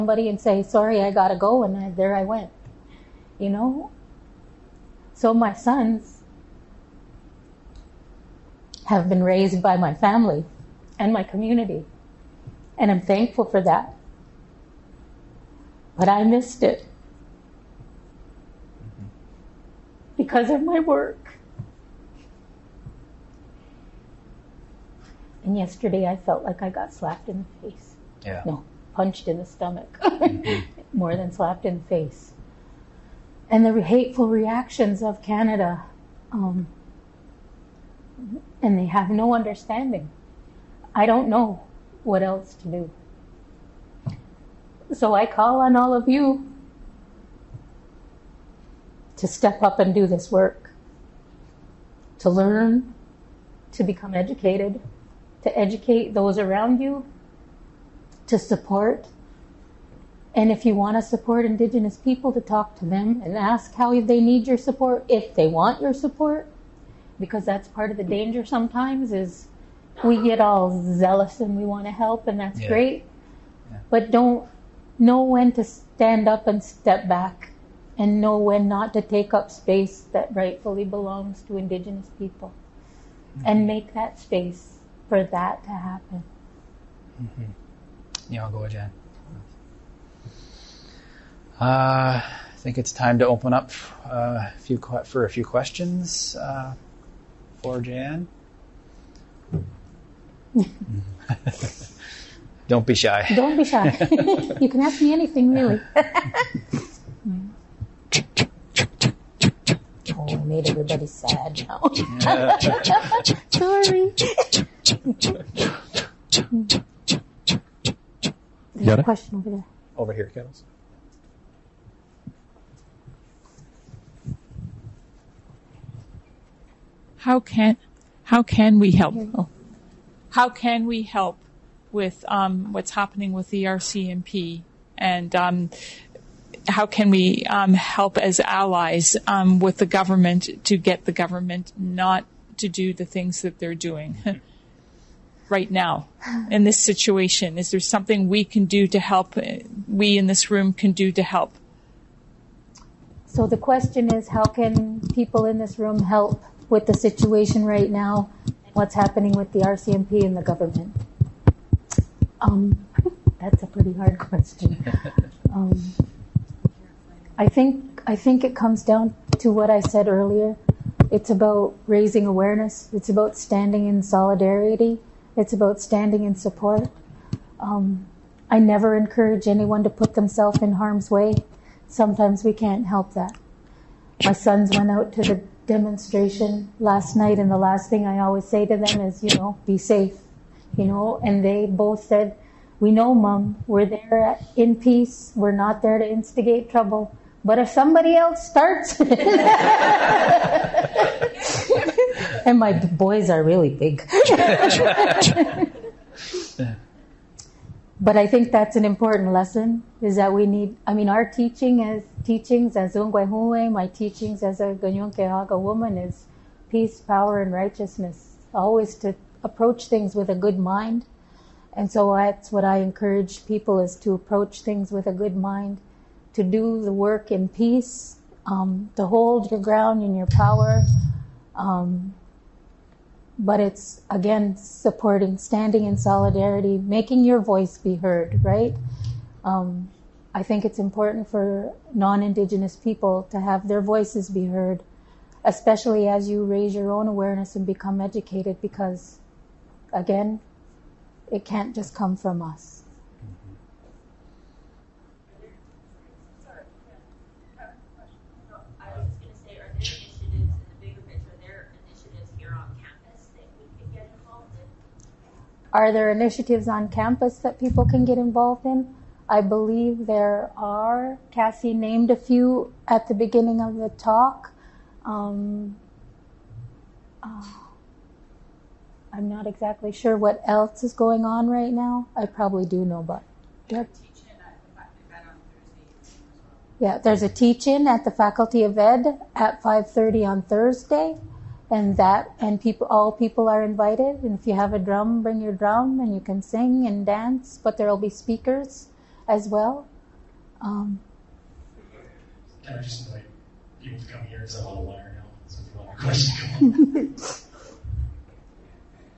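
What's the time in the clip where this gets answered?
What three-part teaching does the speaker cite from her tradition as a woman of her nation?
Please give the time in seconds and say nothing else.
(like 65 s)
216 s.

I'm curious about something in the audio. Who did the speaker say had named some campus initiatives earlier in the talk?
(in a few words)
Kassie.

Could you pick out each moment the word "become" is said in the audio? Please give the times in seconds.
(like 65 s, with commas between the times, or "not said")
53 s, 247 s.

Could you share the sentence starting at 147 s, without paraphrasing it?
Is there something we can do to help?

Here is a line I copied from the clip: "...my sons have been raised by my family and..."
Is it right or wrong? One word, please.
right.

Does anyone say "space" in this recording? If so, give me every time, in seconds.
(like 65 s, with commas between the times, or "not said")
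79 s, 84 s.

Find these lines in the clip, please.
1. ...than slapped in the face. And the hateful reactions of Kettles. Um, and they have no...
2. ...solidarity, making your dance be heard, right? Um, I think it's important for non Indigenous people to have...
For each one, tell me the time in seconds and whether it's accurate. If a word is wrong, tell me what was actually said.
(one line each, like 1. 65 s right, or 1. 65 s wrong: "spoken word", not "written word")
1. 31 s wrong: "Canada", not "Kettles"
2. 235 s wrong: "voice", not "dance".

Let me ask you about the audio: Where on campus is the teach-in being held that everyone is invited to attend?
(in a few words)
Faculty of Ed.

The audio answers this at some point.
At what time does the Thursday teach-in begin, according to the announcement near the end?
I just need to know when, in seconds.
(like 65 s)
289 s.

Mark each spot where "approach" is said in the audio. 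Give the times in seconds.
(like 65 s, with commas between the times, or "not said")
219 s, 224 s.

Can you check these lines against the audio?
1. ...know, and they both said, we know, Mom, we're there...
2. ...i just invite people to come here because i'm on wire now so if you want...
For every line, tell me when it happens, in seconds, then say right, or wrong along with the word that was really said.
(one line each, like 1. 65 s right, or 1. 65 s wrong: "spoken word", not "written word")
1. 190 s right
2. 302 s right.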